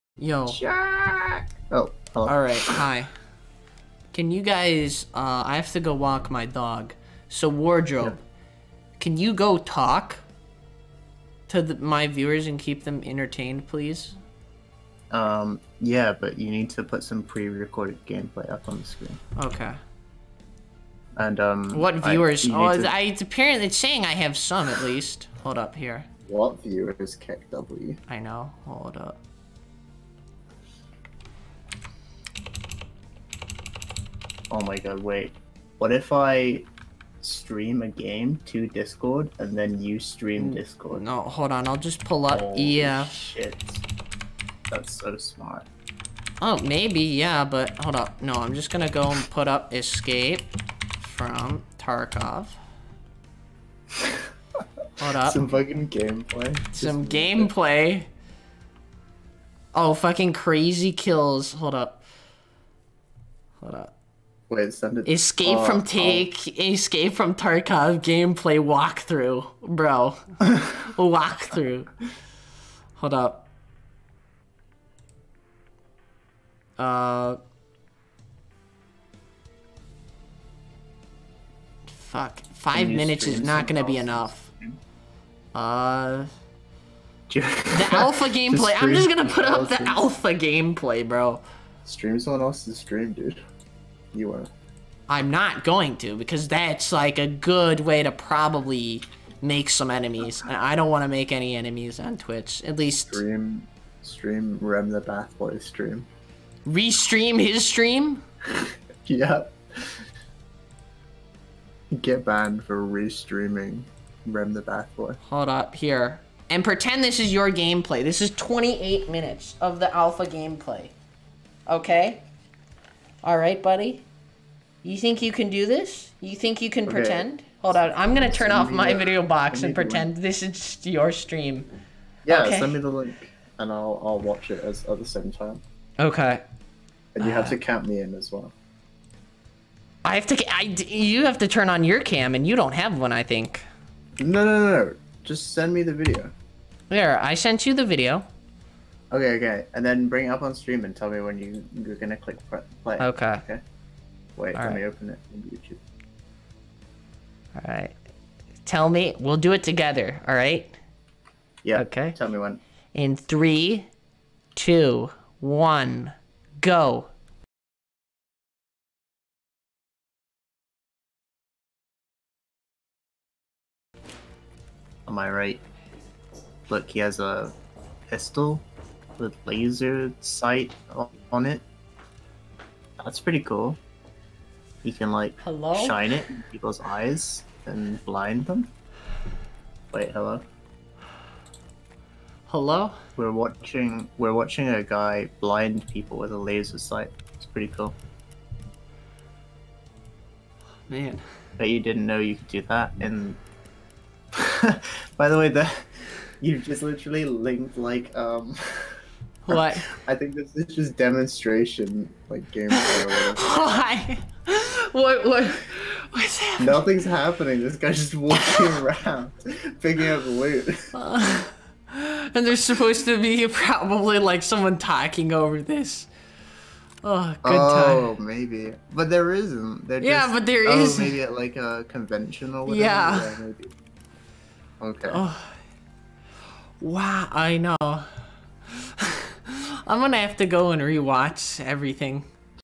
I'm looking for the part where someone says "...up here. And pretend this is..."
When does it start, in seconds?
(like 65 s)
115 s.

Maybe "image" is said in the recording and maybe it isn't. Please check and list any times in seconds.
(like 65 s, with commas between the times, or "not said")
not said.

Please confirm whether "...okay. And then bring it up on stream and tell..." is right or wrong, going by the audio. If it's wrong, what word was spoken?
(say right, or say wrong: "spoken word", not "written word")
right.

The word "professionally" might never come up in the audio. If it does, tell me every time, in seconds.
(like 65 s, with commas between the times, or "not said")
not said.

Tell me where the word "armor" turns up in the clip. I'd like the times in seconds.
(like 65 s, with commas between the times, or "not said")
not said.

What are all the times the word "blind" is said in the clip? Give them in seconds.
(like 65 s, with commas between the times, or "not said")
188 s, 195 s.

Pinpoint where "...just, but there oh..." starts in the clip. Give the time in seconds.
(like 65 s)
230 s.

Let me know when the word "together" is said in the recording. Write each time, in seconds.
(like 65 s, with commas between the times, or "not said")
159 s.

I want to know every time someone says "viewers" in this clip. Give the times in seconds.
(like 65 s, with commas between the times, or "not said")
12 s, 21 s, 26 s.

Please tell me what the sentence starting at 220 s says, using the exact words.
Uh, and there's supposed to be probably like someone talking over this.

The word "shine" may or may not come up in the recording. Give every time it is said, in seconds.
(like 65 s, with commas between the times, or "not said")
185 s.